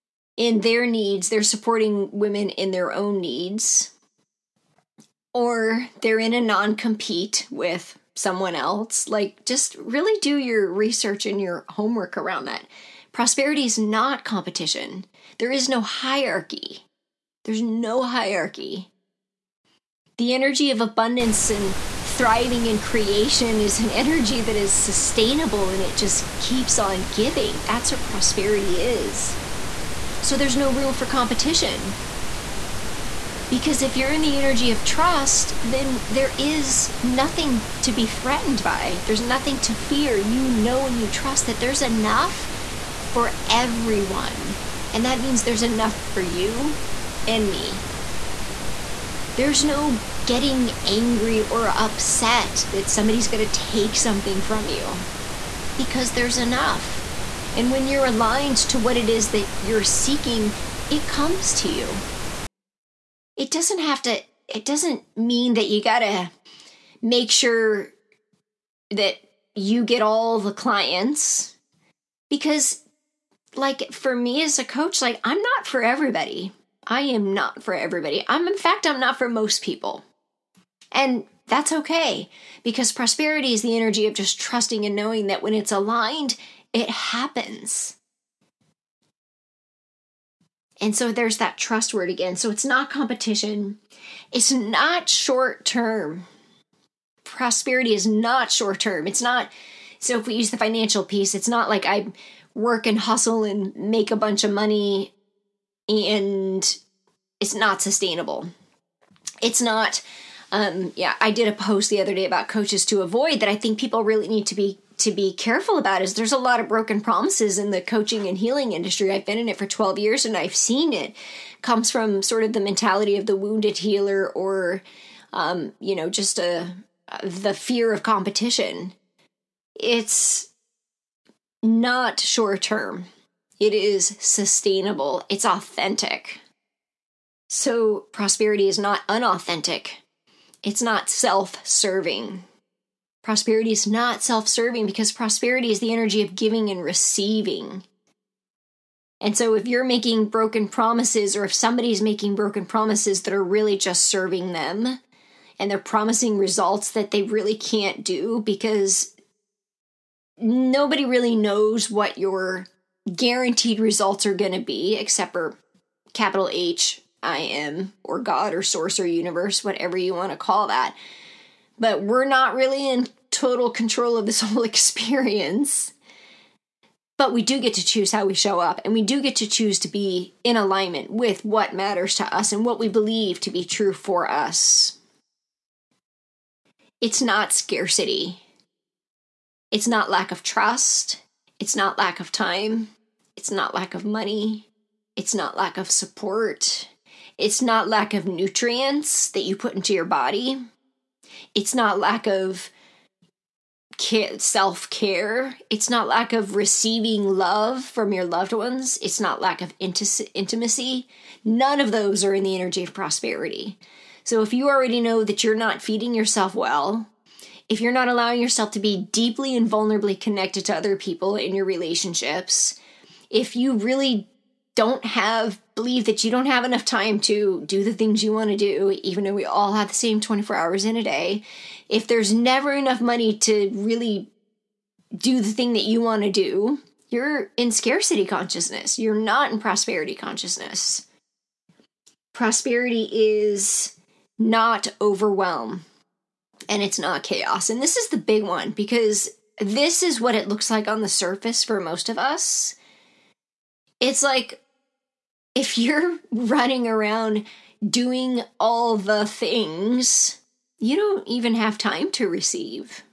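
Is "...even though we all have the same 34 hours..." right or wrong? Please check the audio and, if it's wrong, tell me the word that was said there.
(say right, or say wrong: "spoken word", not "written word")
wrong: "24", not "34".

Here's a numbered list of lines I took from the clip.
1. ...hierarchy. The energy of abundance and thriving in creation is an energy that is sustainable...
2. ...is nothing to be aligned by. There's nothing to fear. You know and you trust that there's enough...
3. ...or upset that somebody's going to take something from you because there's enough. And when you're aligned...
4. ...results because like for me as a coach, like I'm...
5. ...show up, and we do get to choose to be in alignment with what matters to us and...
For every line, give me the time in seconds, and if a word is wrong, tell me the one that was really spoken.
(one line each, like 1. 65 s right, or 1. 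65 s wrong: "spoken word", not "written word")
1. 18 s right
2. 36 s wrong: "threatened", not "aligned"
3. 51 s right
4. 70 s wrong: "clients", not "results"
5. 178 s right.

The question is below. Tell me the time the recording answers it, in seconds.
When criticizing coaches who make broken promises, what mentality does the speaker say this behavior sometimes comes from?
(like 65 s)
123 s.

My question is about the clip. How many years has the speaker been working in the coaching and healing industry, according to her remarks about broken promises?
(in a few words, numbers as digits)
12.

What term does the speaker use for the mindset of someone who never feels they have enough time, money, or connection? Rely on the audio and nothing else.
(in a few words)
scarcity consciousness.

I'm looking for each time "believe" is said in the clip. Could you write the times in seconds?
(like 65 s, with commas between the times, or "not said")
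182 s, 225 s.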